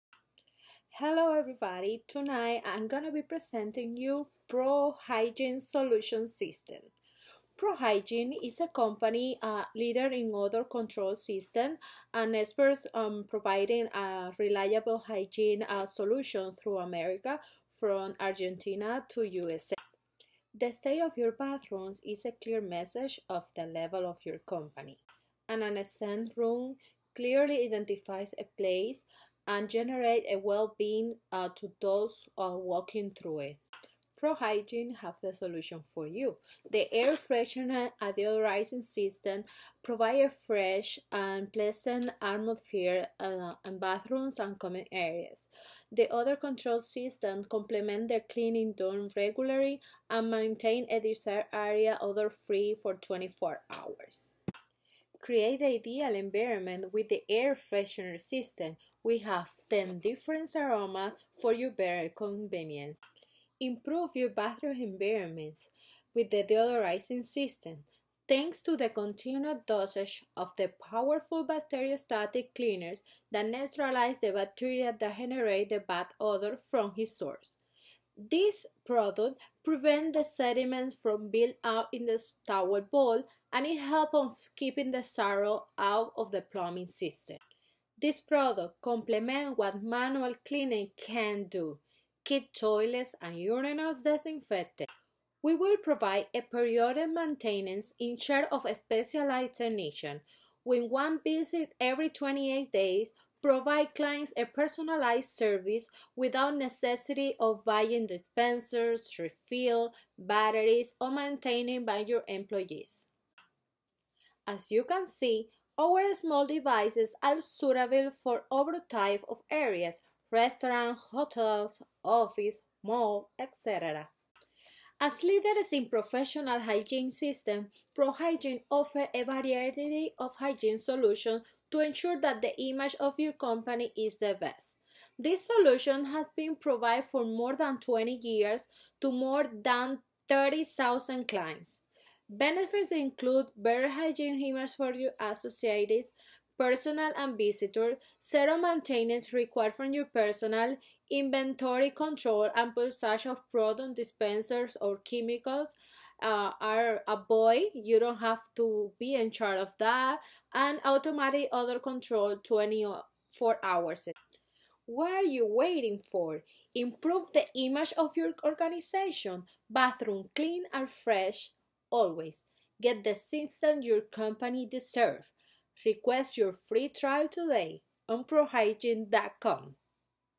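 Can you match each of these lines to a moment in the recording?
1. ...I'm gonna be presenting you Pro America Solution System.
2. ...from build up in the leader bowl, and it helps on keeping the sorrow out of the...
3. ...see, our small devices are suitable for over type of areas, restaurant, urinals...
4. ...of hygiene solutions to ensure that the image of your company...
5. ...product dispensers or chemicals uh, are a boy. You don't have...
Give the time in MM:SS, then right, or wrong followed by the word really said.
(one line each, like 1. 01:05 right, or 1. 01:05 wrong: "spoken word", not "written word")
1. 00:02 wrong: "Hygiene", not "America"
2. 01:20 wrong: "tower", not "leader"
3. 01:55 wrong: "hotels", not "urinals"
4. 02:10 right
5. 02:33 right.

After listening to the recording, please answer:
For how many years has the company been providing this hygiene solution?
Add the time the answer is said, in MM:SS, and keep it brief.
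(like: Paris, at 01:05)
More than 20 years, at 02:17.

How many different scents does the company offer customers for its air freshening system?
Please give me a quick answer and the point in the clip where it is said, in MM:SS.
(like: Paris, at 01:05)
10, at 00:59.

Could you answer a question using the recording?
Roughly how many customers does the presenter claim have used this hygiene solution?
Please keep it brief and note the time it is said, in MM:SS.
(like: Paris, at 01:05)
More than 30,000, at 02:19.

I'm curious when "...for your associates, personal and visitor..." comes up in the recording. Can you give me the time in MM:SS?
02:24.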